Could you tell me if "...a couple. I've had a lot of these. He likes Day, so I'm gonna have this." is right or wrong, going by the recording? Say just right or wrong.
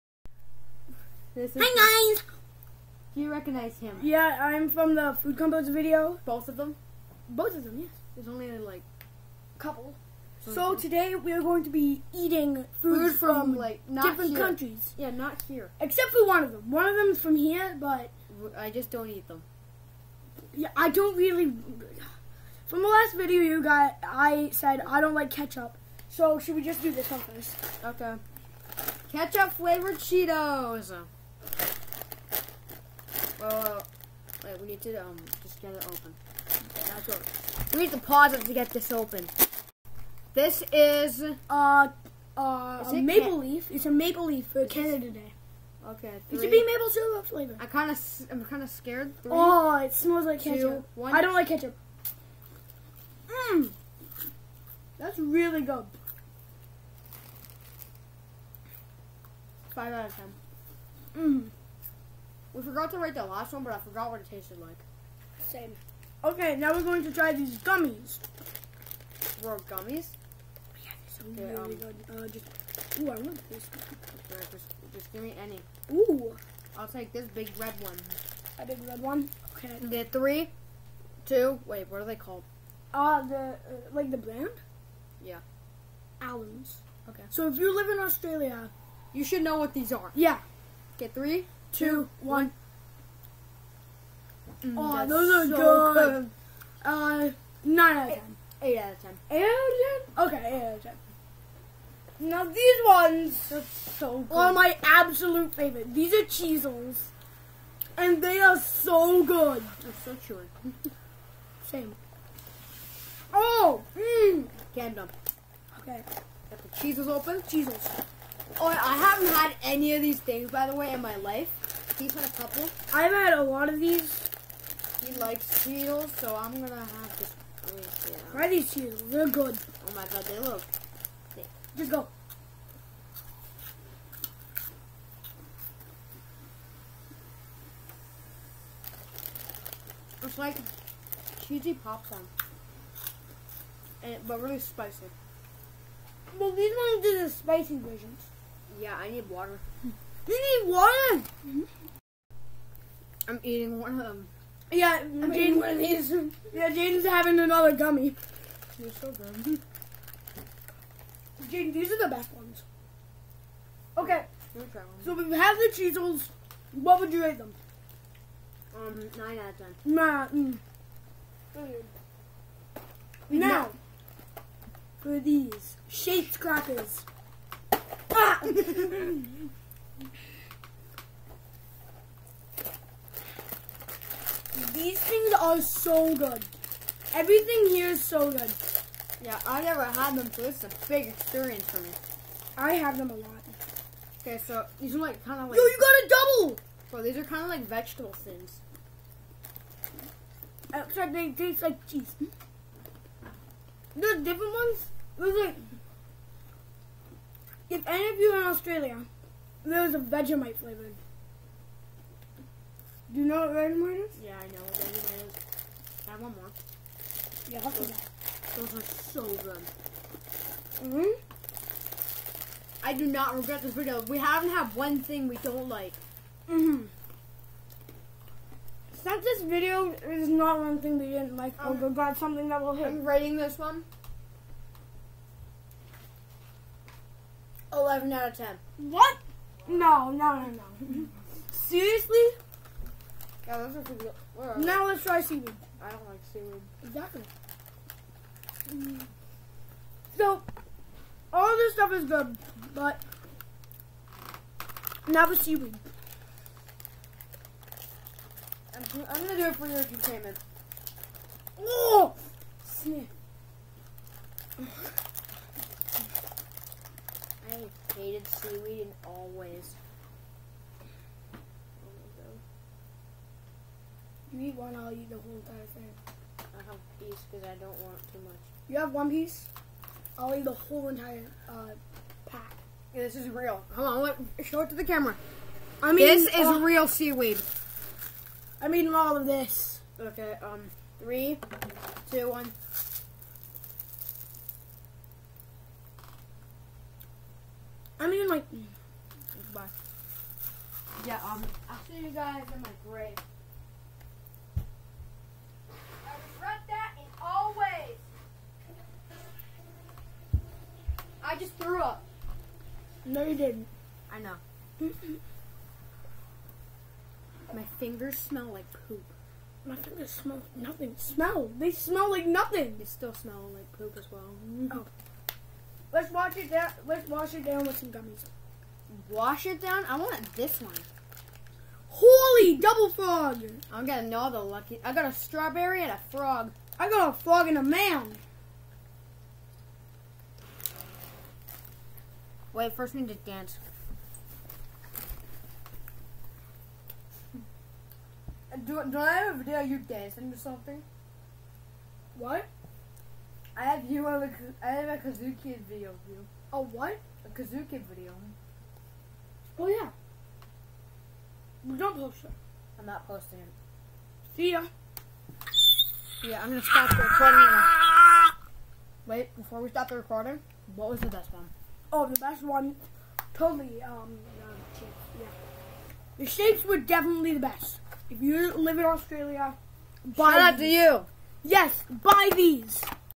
wrong.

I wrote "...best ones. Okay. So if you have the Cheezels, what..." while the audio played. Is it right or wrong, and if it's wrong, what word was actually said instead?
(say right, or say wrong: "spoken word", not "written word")
right.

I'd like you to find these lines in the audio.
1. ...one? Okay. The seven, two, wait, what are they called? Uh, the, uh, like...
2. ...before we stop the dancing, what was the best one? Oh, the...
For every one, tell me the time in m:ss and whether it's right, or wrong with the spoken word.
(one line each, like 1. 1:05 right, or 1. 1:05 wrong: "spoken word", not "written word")
1. 1:19 wrong: "three", not "seven"
2. 6:09 wrong: "recording", not "dancing".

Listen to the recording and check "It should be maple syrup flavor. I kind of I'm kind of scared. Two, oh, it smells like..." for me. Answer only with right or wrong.
wrong.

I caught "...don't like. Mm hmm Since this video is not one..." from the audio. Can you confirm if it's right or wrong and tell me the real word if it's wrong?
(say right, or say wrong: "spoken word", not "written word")
right.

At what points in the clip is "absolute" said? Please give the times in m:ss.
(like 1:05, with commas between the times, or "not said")
1:44.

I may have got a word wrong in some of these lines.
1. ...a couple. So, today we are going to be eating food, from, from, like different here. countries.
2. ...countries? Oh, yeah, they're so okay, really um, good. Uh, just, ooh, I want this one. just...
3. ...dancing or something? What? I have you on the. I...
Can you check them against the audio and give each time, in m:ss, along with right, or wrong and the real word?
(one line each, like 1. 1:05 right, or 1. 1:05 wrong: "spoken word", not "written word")
1. 0:09 right
2. 1:09 wrong: "gummies", not "countries"
3. 5:49 right.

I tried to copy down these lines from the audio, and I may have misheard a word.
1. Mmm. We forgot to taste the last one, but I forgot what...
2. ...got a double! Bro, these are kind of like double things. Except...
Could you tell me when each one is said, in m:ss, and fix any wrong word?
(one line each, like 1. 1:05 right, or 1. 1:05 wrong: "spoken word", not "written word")
1. 1:01 wrong: "write", not "taste"
2. 3:15 wrong: "vegetable", not "double".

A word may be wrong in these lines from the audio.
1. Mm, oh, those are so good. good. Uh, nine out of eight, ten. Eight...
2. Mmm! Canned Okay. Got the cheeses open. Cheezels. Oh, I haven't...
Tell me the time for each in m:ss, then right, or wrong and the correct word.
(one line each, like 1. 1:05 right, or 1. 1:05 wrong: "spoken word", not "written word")
1. 1:34 right
2. 1:53 right.